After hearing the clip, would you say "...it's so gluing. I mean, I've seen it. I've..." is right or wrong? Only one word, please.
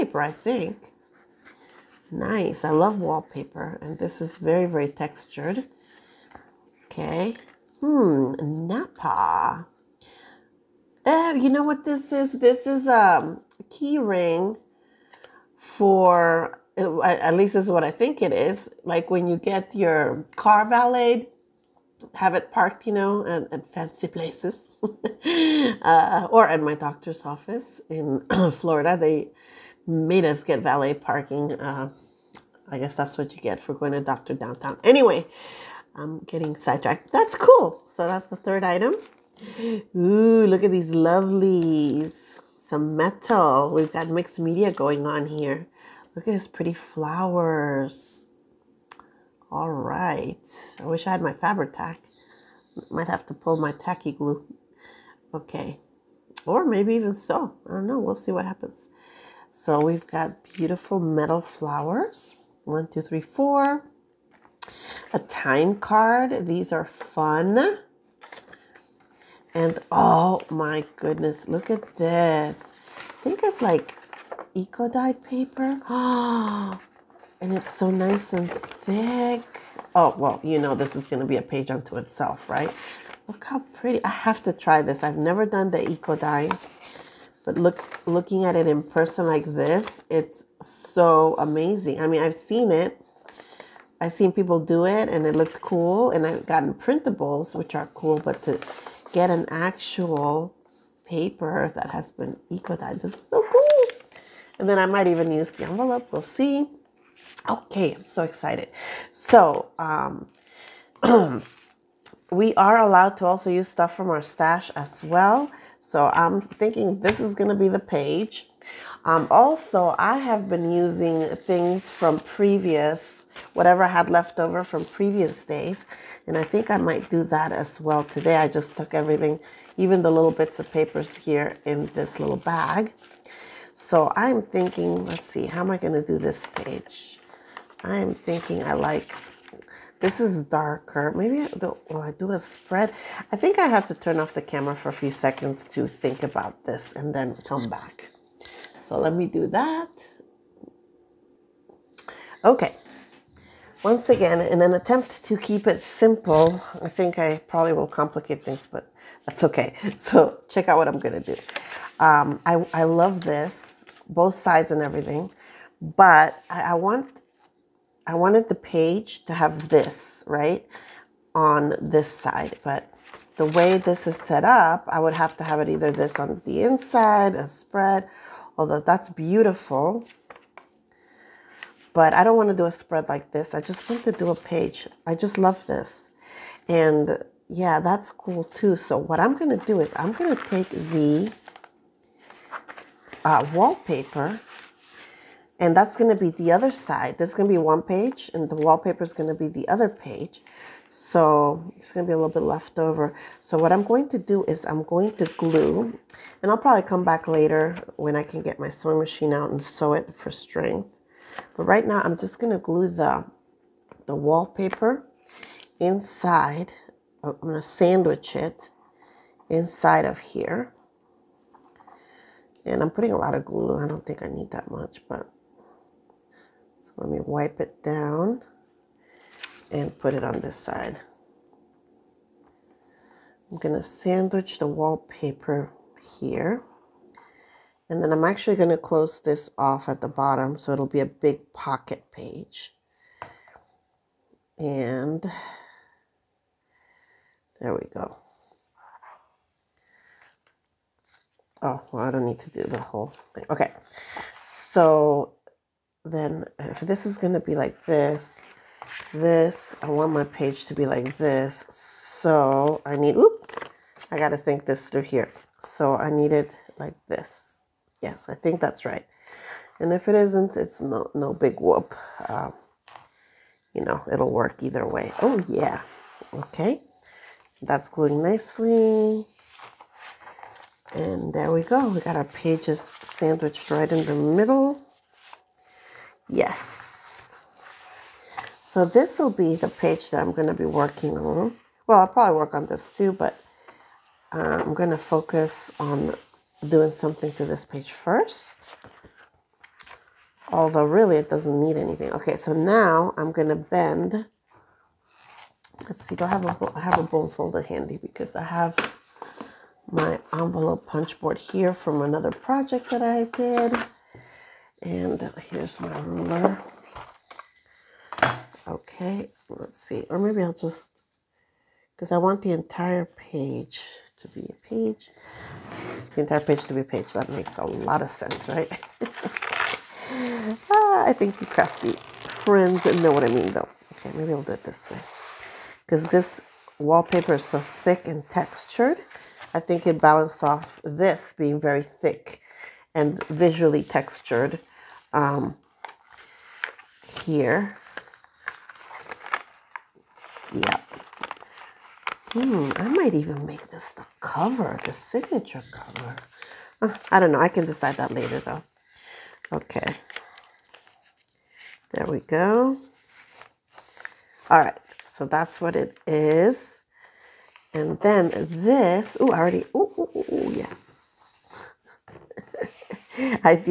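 wrong.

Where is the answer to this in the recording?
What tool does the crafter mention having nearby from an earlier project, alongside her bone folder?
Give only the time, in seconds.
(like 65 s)
310 s.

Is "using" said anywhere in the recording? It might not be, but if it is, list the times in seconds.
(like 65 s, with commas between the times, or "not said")
120 s.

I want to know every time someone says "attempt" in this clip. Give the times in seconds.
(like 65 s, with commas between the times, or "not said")
154 s.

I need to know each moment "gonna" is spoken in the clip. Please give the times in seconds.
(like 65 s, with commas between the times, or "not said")
160 s, 303 s.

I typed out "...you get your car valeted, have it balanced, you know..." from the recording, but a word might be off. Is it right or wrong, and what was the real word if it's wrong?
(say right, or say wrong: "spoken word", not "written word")
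wrong: "parked", not "balanced".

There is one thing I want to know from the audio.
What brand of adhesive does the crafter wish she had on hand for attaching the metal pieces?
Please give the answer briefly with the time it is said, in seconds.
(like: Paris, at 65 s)
Fabri-Tac, at 51 s.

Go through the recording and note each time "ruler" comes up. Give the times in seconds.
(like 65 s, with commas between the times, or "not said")
316 s.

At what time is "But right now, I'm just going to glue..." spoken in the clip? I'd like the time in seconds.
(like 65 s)
211 s.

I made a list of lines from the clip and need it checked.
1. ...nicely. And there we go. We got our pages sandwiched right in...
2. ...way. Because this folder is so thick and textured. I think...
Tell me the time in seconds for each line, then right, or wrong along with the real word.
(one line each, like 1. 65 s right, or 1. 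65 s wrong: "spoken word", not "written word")
1. 278 s right
2. 334 s wrong: "wallpaper", not "folder".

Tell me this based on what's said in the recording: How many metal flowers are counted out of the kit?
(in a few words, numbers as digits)
4.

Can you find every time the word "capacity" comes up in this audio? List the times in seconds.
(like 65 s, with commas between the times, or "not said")
not said.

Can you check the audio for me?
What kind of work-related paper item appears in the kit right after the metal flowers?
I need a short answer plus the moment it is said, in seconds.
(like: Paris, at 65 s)
A time card, at 65 s.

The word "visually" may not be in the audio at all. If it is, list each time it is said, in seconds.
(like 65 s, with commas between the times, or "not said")
343 s.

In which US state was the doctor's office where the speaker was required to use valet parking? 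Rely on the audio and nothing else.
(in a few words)
Florida.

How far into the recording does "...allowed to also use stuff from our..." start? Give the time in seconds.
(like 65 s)
112 s.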